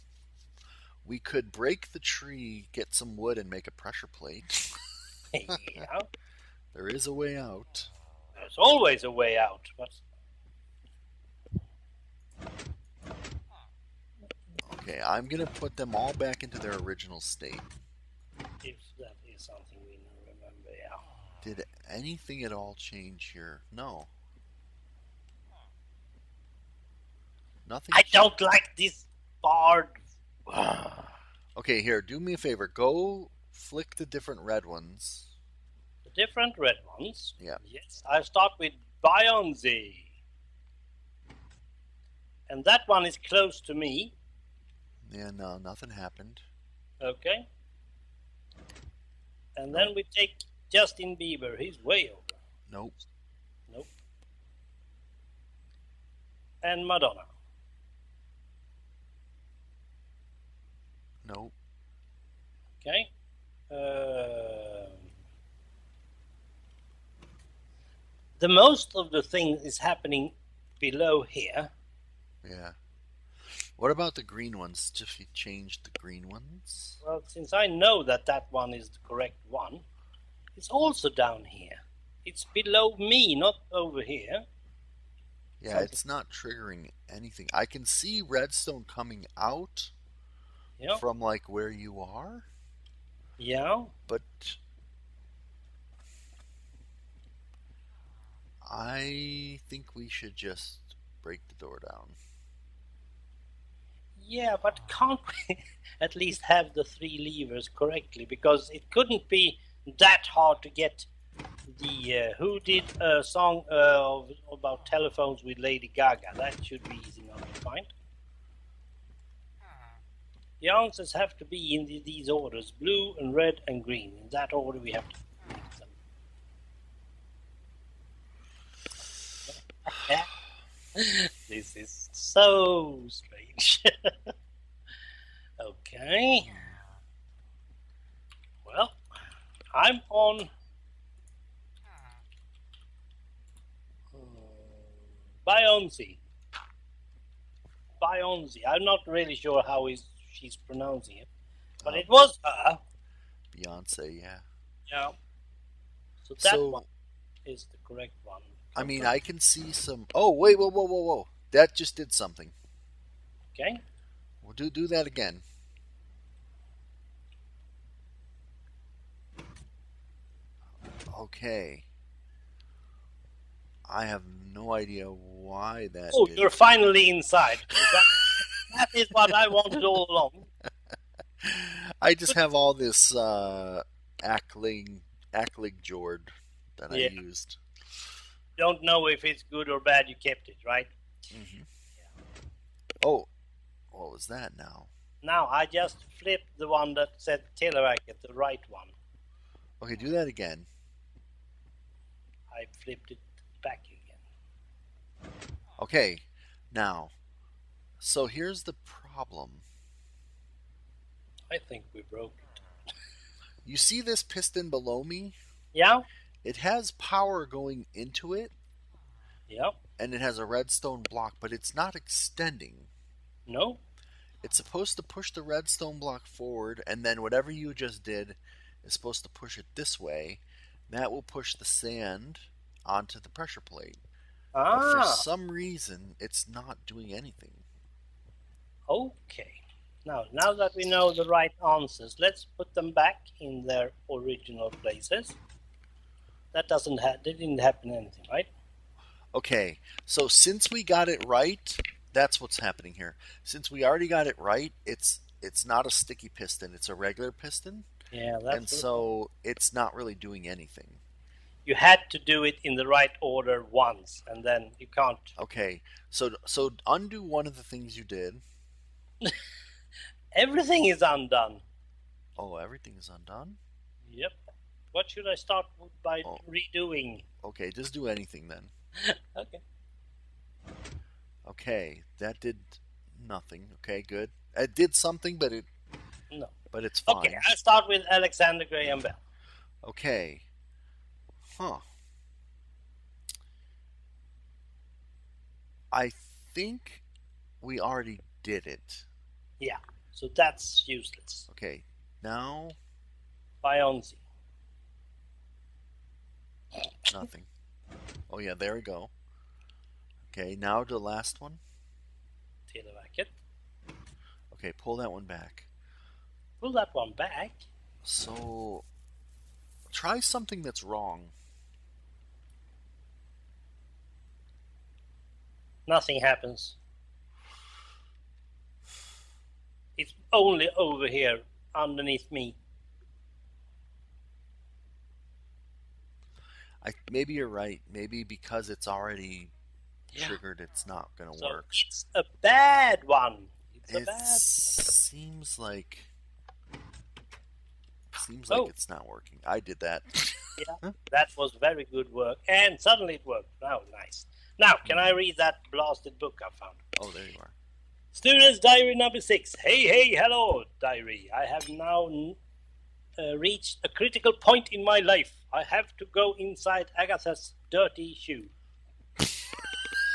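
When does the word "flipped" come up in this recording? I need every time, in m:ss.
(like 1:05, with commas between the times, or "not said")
3:16, 3:22.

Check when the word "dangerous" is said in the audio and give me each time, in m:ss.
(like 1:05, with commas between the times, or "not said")
not said.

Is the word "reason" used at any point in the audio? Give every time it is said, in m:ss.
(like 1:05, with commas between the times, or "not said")
3:55.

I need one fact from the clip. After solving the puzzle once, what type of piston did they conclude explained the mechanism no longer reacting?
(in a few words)
Regular piston.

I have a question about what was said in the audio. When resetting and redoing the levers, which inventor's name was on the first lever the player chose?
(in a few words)
Alexander Graham Bell.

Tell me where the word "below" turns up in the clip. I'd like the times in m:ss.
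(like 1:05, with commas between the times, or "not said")
1:10, 1:22, 3:34.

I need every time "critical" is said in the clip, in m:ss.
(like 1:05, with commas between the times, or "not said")
6:03.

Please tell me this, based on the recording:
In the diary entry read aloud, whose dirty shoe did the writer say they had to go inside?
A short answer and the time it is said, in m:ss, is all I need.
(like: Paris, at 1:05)
Agatha's, at 6:06.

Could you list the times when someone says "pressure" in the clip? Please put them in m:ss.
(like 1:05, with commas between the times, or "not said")
0:03, 3:53.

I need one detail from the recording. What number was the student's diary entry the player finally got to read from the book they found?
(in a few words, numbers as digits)
6.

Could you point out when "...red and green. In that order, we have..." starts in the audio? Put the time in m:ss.
2:03.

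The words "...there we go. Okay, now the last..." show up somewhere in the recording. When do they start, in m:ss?
5:08.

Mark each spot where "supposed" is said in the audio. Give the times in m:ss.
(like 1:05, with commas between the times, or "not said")
3:44, 3:48.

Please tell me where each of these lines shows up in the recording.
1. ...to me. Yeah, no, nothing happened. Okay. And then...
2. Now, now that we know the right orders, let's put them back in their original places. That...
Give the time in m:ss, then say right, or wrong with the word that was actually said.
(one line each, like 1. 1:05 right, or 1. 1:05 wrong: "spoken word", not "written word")
1. 0:43 right
2. 4:00 wrong: "answers", not "orders".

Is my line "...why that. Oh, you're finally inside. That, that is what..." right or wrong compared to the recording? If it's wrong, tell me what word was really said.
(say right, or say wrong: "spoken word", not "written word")
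right.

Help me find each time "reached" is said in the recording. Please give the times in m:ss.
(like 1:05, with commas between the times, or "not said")
6:03.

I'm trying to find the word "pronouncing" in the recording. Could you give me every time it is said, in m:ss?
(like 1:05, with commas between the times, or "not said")
2:30.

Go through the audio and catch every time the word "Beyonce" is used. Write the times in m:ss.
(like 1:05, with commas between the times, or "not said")
2:33.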